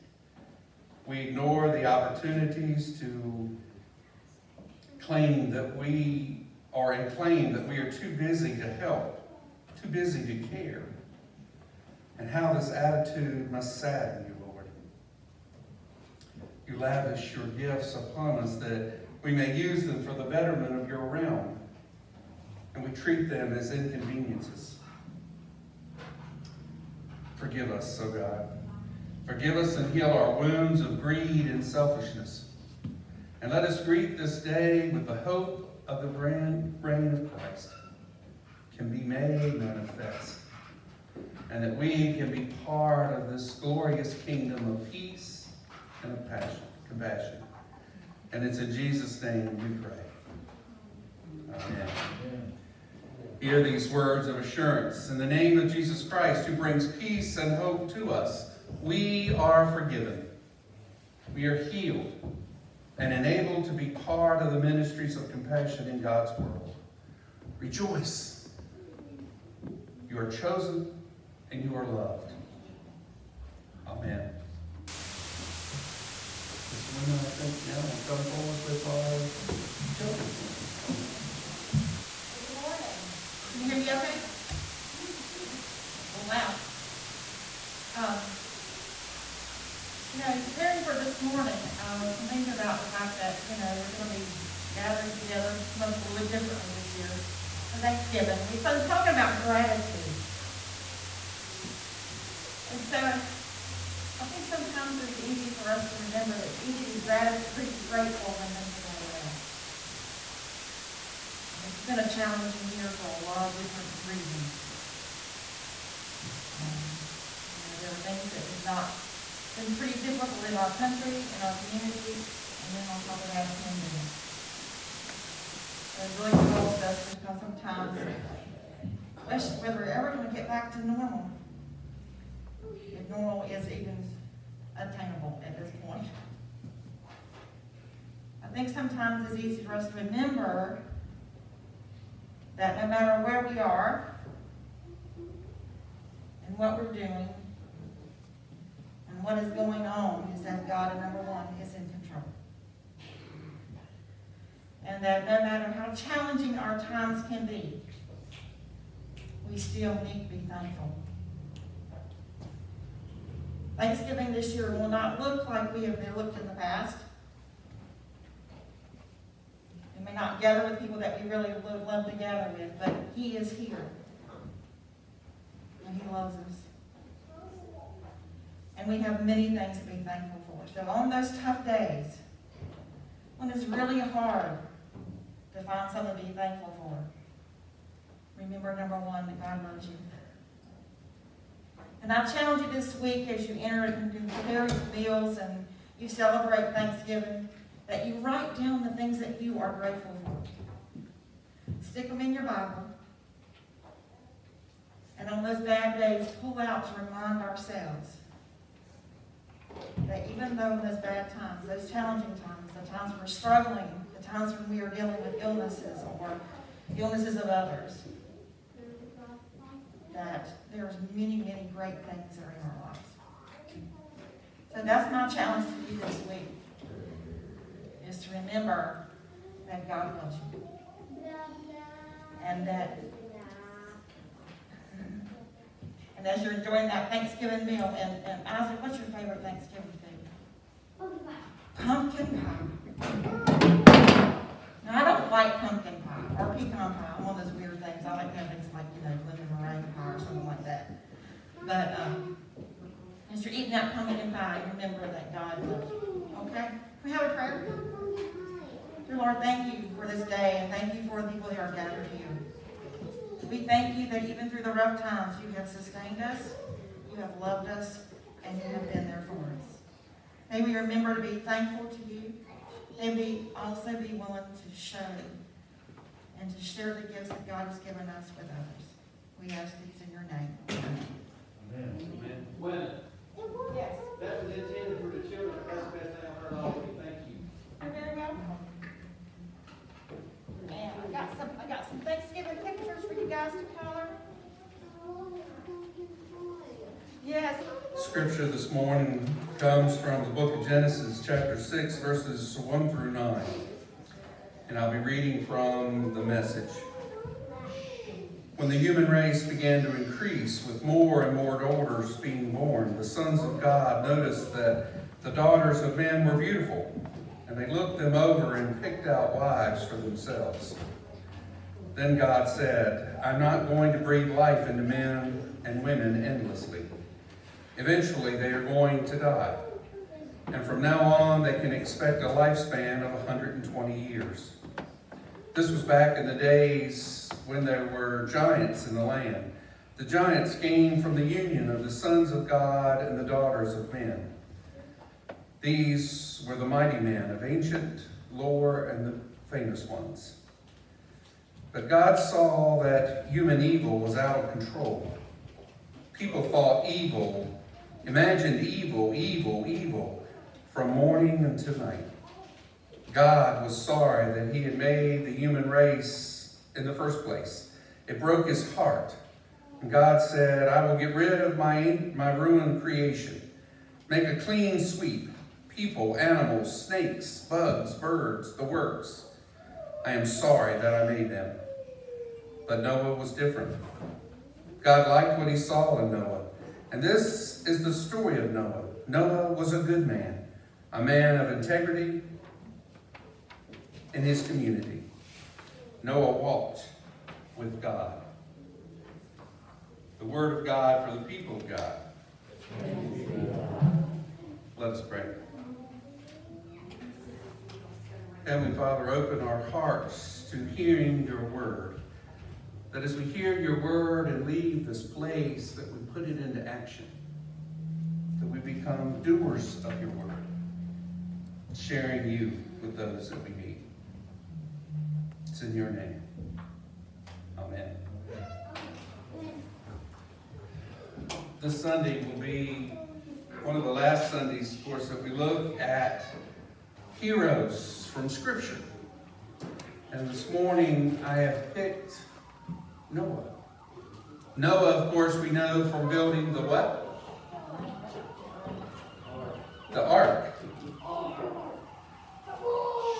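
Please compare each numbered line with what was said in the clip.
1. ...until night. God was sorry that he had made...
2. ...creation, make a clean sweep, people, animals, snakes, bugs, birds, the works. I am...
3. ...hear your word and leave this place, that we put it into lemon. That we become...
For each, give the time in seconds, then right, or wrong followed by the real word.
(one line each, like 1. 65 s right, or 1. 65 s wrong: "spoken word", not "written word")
1. 361 s right
2. 372 s right
3. 413 s wrong: "action", not "lemon".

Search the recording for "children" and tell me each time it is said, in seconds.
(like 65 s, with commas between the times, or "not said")
79 s, 285 s.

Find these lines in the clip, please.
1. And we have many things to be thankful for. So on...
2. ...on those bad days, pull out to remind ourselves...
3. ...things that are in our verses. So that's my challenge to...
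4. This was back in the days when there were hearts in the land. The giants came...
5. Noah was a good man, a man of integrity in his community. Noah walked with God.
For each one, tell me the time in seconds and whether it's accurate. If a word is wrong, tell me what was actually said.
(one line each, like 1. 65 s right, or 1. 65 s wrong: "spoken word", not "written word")
1. 178 s right
2. 205 s right
3. 222 s wrong: "lives", not "verses"
4. 335 s wrong: "giants", not "hearts"
5. 389 s right.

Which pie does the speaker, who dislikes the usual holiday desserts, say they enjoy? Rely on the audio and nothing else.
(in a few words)
Lemon meringue pie.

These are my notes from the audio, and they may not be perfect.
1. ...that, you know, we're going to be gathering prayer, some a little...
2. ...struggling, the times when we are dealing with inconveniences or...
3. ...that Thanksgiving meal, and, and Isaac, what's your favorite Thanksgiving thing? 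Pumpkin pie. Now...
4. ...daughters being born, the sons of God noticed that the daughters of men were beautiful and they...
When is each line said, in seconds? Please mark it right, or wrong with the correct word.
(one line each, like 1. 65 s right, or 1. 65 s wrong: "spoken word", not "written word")
1. 93 s wrong: "together", not "prayer"
2. 213 s wrong: "illnesses", not "inconveniences"
3. 236 s right
4. 311 s right.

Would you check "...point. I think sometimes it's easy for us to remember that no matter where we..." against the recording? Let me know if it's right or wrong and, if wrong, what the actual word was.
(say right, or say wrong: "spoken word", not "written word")
right.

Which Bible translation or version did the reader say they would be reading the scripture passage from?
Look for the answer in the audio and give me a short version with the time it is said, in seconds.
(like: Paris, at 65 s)
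The Message, at 306 s.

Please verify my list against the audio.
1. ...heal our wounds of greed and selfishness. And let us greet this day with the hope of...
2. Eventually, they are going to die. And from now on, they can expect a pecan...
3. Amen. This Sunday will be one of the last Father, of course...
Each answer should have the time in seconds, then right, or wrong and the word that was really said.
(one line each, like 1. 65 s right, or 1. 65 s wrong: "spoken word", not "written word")
1. 29 s right
2. 327 s wrong: "lifespan", not "pecan"
3. 427 s wrong: "Sundays", not "Father".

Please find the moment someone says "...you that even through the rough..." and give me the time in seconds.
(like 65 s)
263 s.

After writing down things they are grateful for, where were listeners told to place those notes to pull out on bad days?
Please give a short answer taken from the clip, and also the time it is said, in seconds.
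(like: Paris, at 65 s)
In your Bible, at 201 s.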